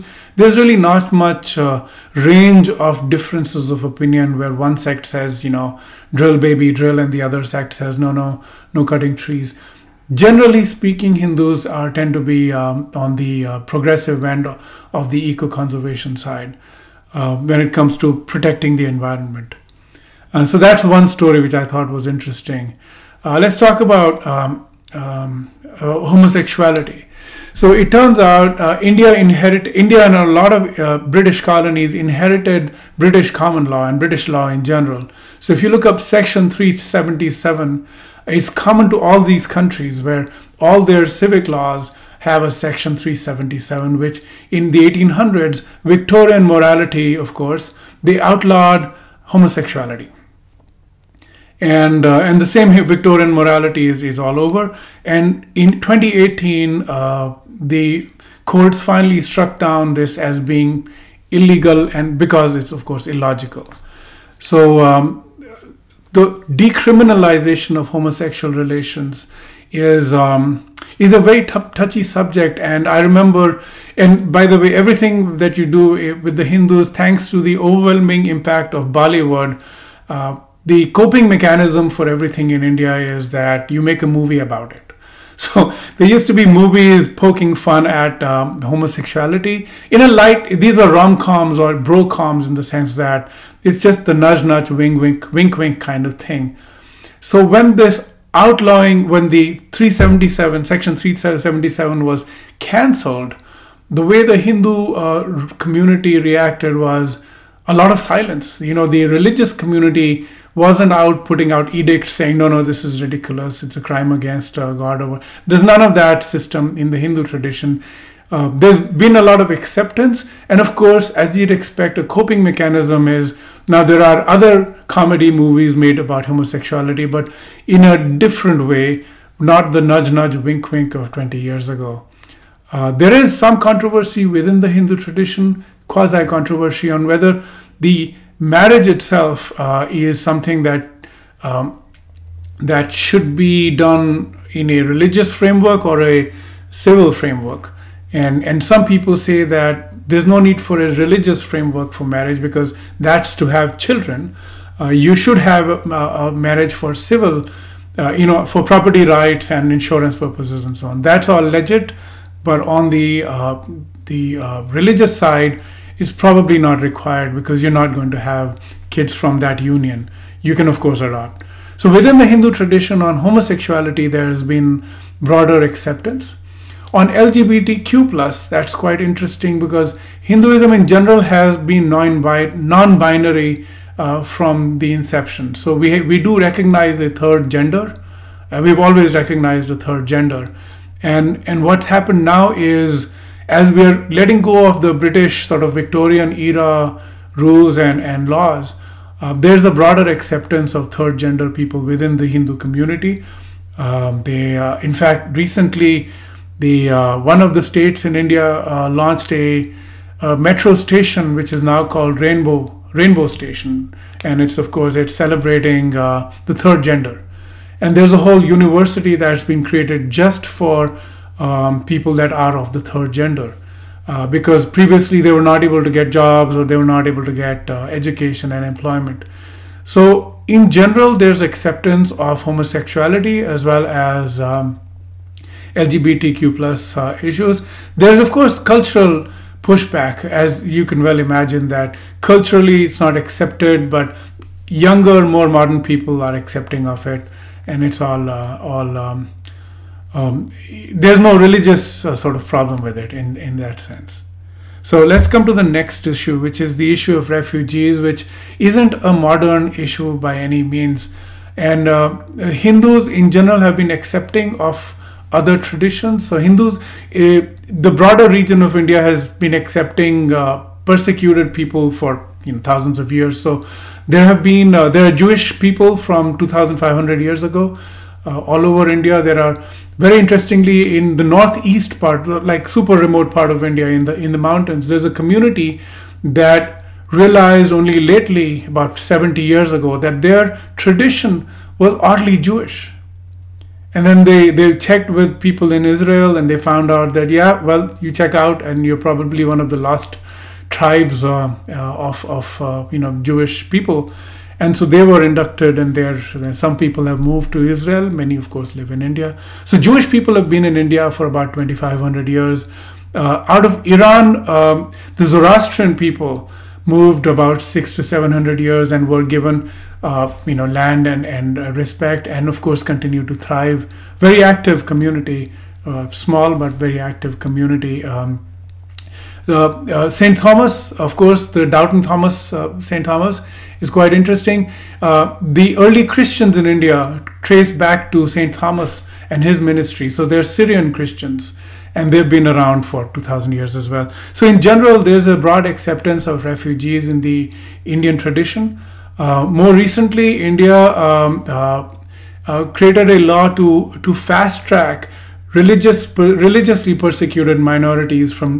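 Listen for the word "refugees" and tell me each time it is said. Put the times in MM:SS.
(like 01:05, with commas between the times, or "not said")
04:17, 05:46.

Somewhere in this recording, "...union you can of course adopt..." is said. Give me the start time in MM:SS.
02:49.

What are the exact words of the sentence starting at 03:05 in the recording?
So we, we do recognize a third gender.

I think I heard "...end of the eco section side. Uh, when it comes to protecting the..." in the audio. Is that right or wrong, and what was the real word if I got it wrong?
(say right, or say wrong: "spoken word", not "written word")
wrong: "conservation", not "section".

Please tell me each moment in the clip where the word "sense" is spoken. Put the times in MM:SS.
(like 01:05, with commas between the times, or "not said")
01:32, 04:13.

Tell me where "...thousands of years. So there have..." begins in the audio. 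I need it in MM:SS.
04:32.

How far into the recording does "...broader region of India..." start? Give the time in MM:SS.
04:27.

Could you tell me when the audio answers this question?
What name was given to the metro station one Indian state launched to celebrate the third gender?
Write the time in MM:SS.
03:32.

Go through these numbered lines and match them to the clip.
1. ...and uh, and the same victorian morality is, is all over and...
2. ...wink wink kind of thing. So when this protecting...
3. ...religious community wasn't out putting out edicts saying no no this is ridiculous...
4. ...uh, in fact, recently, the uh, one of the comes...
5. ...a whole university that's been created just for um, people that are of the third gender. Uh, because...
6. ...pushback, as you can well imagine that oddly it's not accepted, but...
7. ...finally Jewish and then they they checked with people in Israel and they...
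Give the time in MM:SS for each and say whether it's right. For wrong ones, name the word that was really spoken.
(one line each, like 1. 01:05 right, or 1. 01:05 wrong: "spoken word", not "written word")
1. 00:51 right
2. 01:35 wrong: "outlawing", not "protecting"
3. 01:49 right
4. 03:24 wrong: "states", not "comes"
5. 03:38 right
6. 03:59 wrong: "culturally", not "oddly"
7. 04:51 wrong: "oddly", not "finally".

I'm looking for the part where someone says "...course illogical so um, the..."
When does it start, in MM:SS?
01:02.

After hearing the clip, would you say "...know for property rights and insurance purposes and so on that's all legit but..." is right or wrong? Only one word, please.
right.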